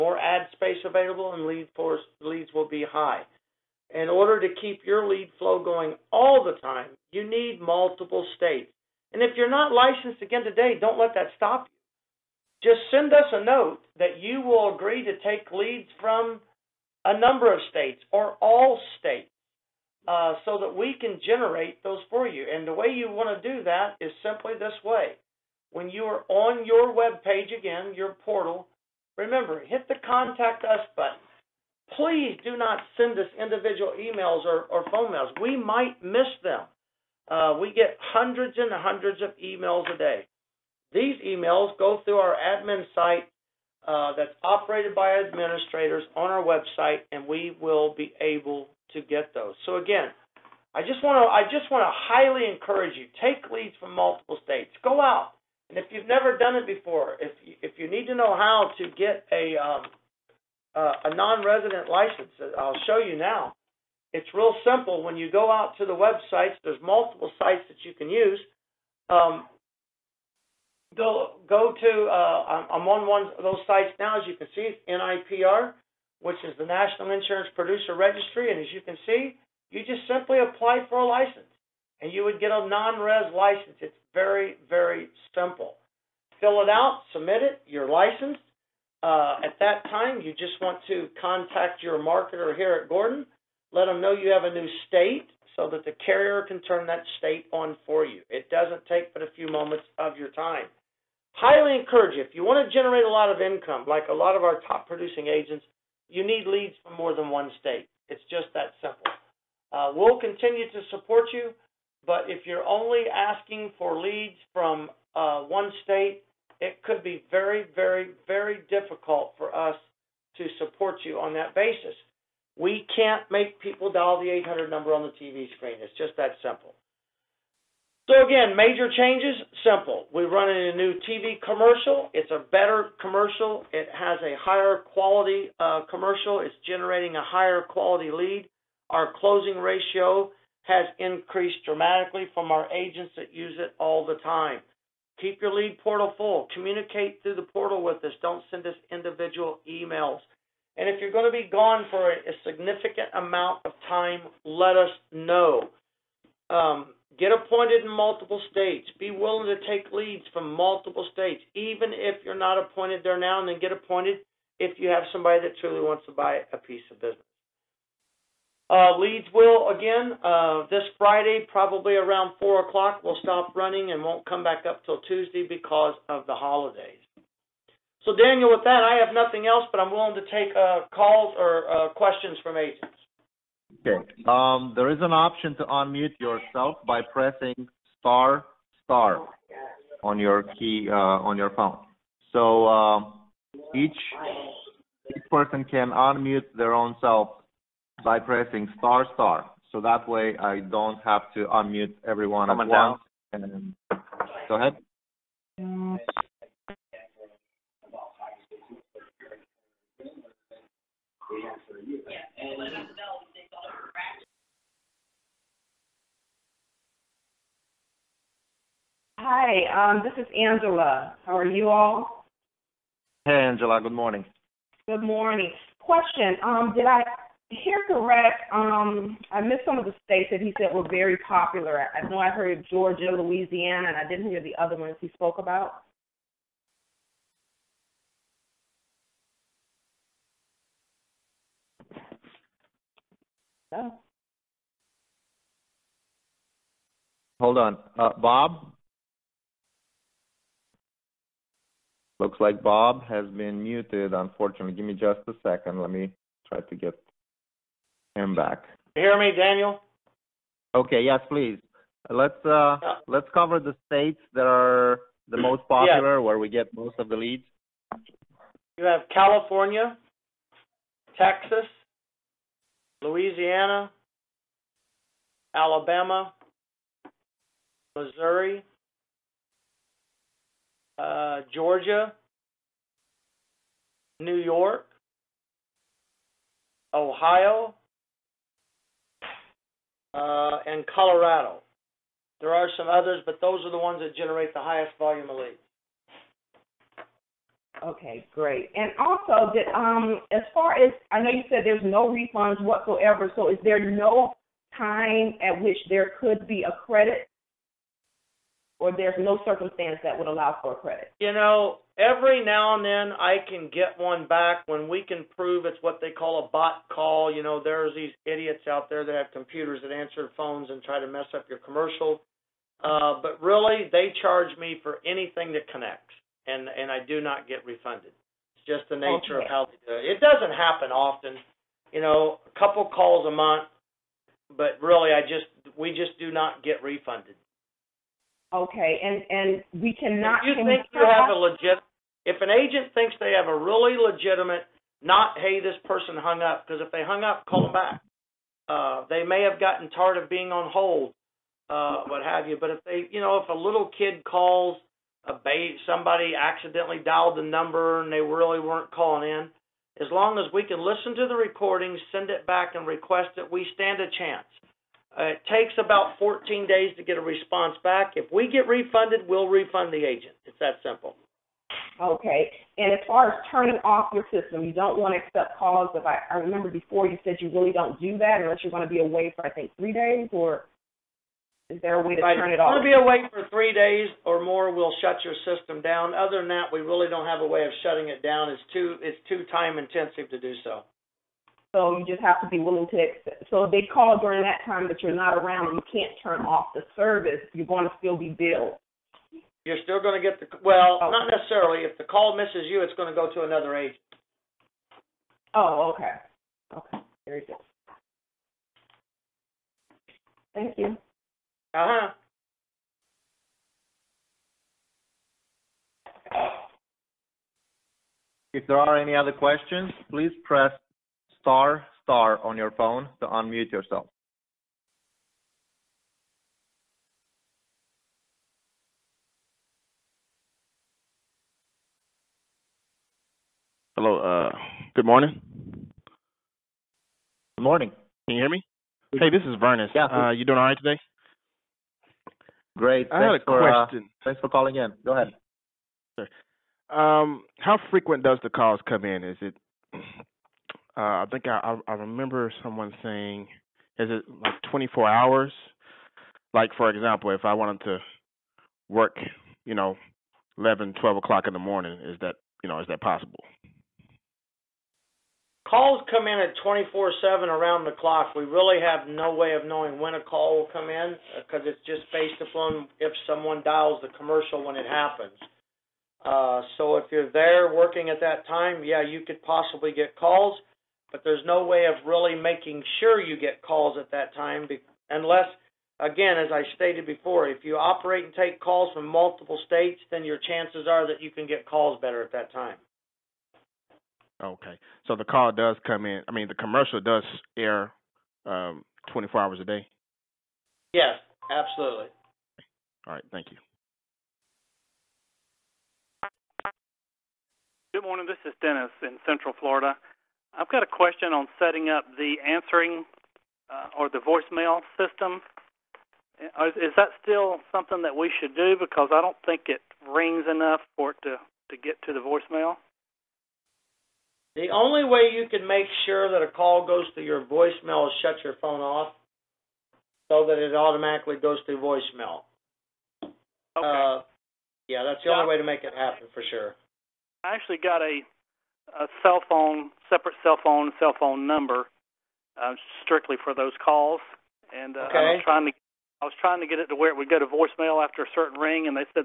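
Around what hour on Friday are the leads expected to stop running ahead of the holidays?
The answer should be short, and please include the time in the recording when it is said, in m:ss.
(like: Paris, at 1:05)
4 o'clock, at 2:52.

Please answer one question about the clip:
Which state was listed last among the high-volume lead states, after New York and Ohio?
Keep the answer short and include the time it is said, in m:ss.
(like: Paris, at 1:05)
Colorado, at 4:50.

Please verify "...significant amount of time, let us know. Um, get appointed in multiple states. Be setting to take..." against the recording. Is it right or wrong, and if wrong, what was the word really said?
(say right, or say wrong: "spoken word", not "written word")
wrong: "willing", not "setting".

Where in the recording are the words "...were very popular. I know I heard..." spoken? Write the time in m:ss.
3:50.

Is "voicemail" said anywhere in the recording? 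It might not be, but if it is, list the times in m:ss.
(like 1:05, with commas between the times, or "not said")
8:34, 8:42, 8:47, 8:51, 9:07.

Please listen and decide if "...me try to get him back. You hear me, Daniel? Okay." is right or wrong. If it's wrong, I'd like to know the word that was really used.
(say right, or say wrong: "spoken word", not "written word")
right.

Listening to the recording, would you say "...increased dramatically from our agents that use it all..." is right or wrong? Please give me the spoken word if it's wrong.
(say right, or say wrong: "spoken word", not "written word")
right.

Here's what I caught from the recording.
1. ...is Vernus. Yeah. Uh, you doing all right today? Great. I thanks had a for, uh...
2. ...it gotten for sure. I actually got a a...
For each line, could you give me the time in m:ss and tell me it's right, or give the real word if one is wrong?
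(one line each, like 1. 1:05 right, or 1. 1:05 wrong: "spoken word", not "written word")
1. 7:19 right
2. 8:55 wrong: "happen", not "gotten".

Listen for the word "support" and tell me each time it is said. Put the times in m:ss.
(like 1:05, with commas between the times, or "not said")
1:50, 2:00.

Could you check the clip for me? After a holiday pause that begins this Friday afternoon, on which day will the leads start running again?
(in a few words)
Tuesday.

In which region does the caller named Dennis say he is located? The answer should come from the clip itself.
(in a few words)
Central Florida.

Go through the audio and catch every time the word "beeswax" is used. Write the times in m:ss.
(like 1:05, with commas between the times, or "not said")
not said.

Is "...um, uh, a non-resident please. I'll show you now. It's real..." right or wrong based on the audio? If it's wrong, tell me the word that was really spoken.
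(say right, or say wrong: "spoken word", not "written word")
wrong: "license", not "please".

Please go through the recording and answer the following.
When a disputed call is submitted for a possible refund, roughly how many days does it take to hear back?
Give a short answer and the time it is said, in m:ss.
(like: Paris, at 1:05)
14 days, at 6:06.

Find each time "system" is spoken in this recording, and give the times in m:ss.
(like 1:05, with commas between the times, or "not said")
6:14, 6:25, 8:34.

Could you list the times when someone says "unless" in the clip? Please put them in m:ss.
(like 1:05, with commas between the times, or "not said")
6:18, 8:05.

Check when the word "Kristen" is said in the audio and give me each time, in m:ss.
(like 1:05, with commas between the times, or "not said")
not said.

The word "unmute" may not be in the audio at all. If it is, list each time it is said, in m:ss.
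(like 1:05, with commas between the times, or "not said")
3:05, 3:15, 3:21, 7:03.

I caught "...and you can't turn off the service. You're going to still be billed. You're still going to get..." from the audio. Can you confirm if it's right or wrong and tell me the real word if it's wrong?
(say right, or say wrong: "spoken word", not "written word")
right.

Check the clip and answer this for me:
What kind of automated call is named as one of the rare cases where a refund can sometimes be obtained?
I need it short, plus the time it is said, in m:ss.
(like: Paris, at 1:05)
bot call, at 5:16.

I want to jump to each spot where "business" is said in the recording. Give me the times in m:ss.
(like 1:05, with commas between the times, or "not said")
2:46.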